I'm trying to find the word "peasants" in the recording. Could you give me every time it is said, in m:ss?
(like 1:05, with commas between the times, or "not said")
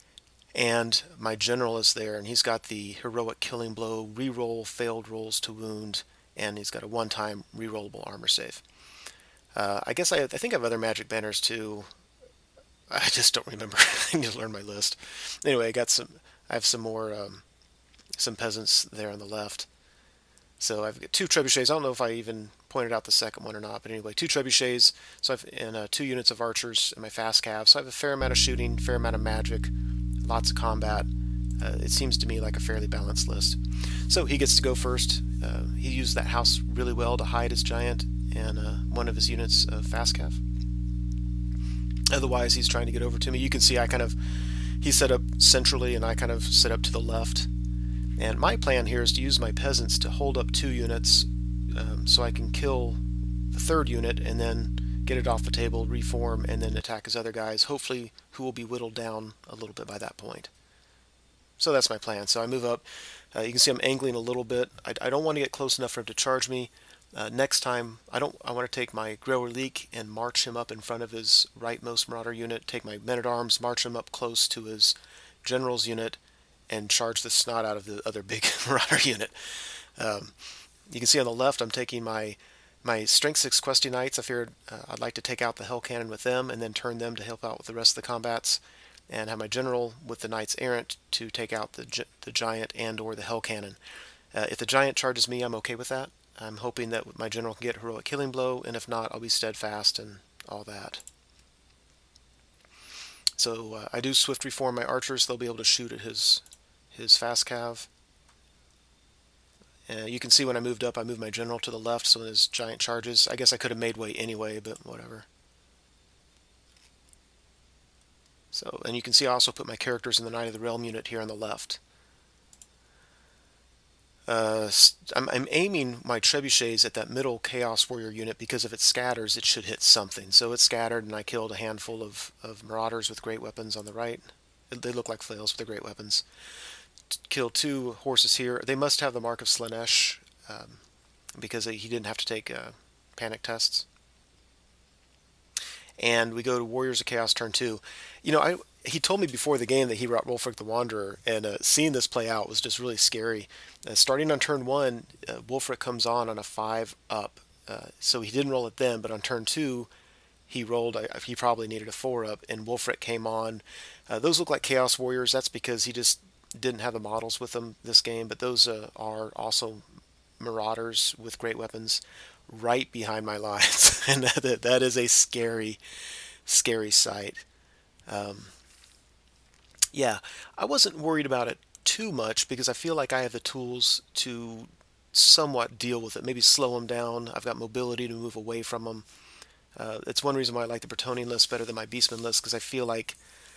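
0:18, 0:49.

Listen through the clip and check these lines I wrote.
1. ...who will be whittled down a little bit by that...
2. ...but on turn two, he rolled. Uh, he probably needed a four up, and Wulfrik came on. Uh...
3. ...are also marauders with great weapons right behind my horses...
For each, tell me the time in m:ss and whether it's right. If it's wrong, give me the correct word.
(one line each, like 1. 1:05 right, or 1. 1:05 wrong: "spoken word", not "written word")
1. 0:58 right
2. 2:39 right
3. 2:48 wrong: "lines", not "horses".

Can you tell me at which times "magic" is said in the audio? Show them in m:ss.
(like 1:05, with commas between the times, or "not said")
0:10, 0:29.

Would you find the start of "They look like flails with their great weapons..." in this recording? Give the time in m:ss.
2:14.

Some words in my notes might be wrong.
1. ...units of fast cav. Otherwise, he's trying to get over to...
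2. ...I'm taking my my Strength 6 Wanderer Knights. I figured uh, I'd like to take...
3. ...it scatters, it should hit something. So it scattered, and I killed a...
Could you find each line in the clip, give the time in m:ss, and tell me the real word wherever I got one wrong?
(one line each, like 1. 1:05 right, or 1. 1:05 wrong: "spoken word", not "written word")
1. 0:39 right
2. 1:21 wrong: "Questing", not "Wanderer"
3. 2:08 right.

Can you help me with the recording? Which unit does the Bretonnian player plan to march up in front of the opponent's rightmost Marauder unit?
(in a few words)
Grail Reliquae.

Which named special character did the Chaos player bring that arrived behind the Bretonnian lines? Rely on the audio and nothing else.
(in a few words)
Wulfrik the Wanderer.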